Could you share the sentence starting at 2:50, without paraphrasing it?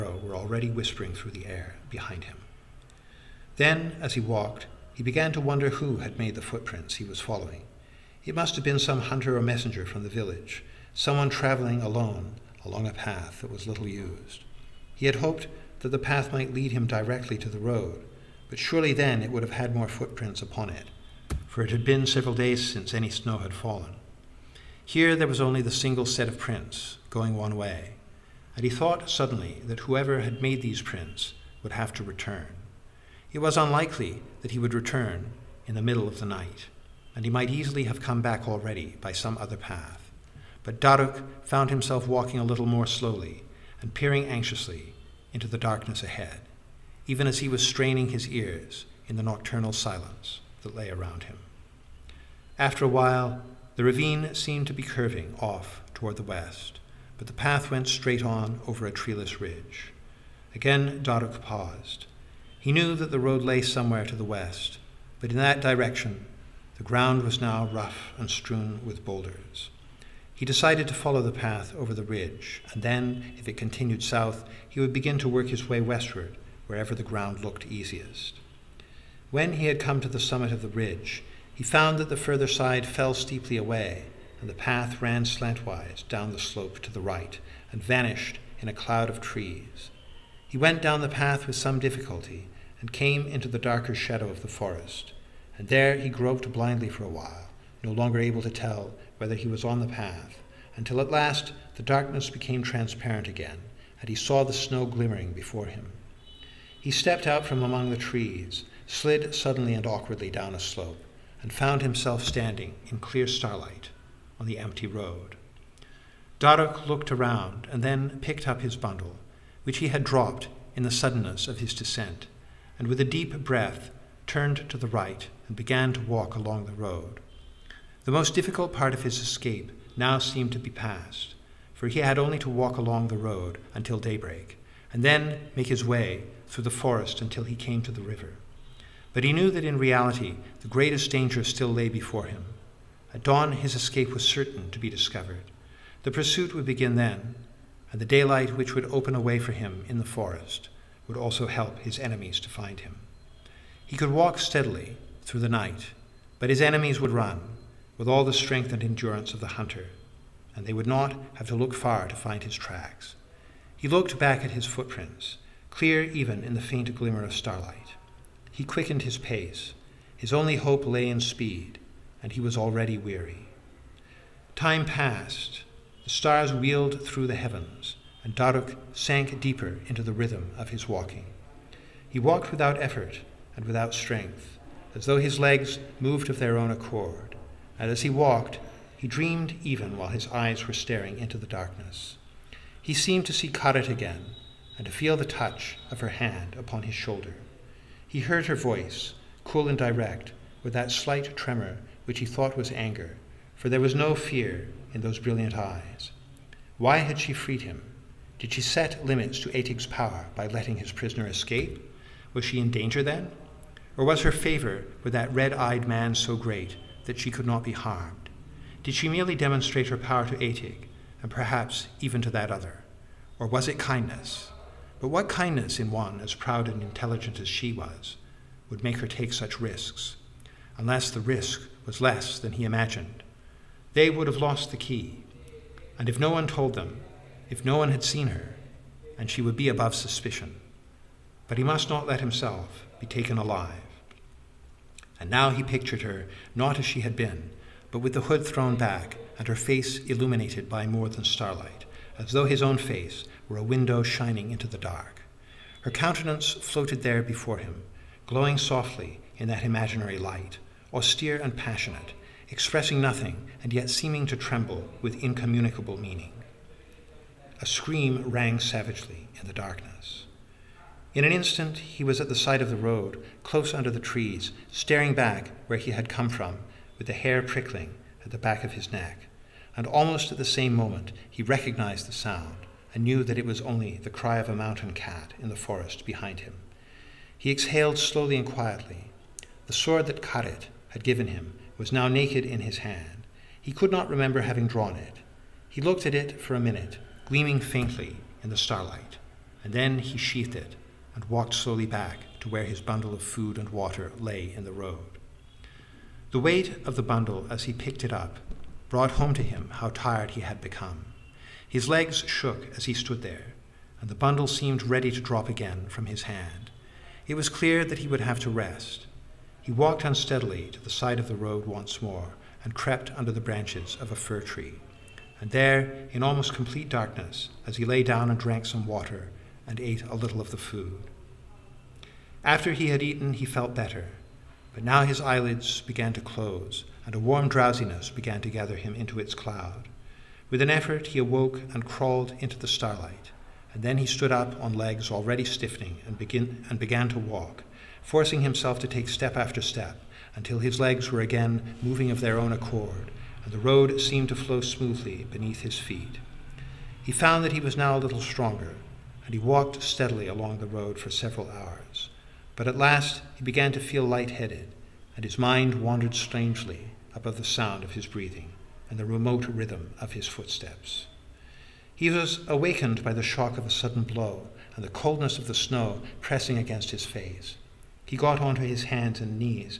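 His only hope lay in speed, and he was already weary.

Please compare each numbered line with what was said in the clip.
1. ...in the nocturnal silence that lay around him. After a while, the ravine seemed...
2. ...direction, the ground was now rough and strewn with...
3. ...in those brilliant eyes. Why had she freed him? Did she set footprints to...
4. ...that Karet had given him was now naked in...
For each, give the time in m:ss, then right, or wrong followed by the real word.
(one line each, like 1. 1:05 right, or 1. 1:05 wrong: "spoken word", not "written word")
1. 0:49 right
2. 1:05 right
3. 3:24 wrong: "limits", not "footprints"
4. 4:50 right.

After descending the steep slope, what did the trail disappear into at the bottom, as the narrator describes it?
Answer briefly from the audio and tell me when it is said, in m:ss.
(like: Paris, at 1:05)
A cloud of trees, at 1:28.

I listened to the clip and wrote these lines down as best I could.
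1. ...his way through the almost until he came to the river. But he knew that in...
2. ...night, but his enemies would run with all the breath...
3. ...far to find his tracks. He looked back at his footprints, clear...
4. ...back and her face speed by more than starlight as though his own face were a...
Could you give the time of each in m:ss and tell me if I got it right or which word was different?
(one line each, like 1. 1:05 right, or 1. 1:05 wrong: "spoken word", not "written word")
1. 2:15 wrong: "forest", not "almost"
2. 2:35 wrong: "strength", not "breath"
3. 2:41 right
4. 4:08 wrong: "illuminated", not "speed".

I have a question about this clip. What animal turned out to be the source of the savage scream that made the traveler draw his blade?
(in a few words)
Mountain cat.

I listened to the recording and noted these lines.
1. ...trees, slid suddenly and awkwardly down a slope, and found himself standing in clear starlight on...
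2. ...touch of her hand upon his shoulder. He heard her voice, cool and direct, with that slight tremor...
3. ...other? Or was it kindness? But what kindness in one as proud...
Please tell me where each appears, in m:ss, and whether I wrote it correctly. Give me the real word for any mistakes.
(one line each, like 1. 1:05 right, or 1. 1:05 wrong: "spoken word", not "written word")
1. 1:47 right
2. 3:15 right
3. 3:42 right.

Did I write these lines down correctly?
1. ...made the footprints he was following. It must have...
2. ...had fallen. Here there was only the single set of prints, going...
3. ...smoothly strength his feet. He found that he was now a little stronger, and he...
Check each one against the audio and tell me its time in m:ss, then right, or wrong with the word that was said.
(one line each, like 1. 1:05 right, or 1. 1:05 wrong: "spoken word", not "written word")
1. 0:06 right
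2. 0:23 right
3. 5:54 wrong: "beneath", not "strength".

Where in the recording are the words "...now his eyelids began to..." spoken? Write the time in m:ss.
5:34.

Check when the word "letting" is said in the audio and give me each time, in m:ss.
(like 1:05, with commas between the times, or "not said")
3:30.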